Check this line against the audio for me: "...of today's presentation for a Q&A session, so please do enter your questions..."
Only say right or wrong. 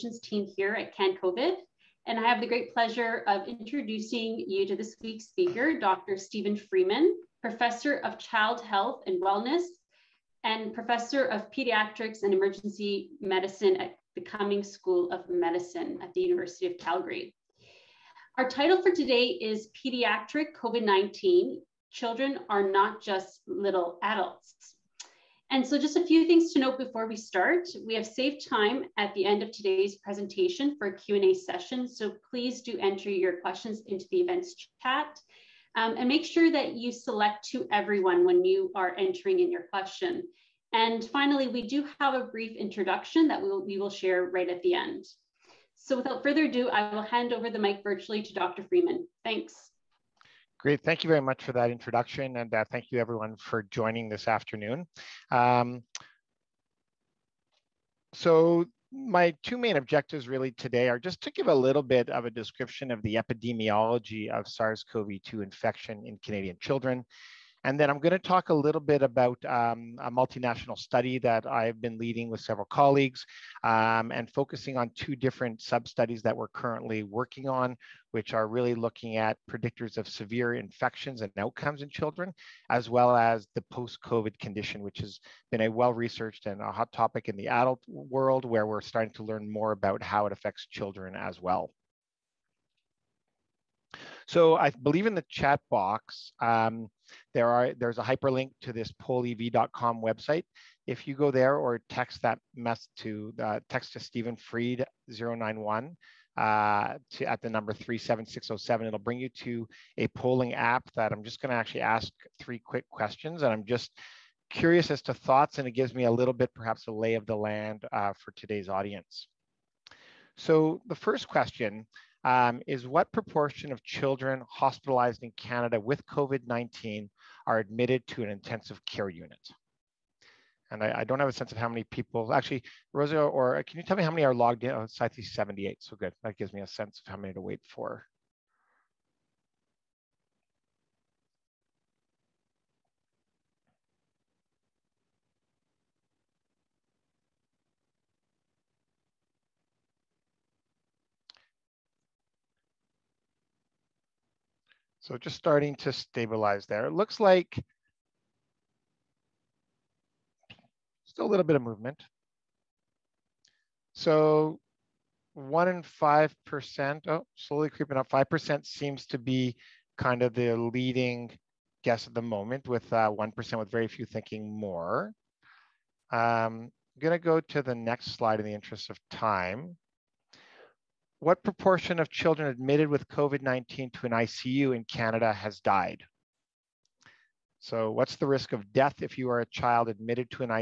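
right.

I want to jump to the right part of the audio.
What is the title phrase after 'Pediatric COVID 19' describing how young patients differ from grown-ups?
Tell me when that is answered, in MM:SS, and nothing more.
00:21.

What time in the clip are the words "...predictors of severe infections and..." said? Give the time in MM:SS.
01:19.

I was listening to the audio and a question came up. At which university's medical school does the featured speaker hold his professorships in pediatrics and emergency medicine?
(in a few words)
University of Calgary.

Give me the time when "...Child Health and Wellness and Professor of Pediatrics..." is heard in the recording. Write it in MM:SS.
00:08.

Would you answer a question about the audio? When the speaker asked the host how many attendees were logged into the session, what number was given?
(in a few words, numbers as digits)
78.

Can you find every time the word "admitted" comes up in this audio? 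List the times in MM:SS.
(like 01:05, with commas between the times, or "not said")
02:07, 03:02, 03:09.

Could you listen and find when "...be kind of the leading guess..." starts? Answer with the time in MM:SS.
02:49.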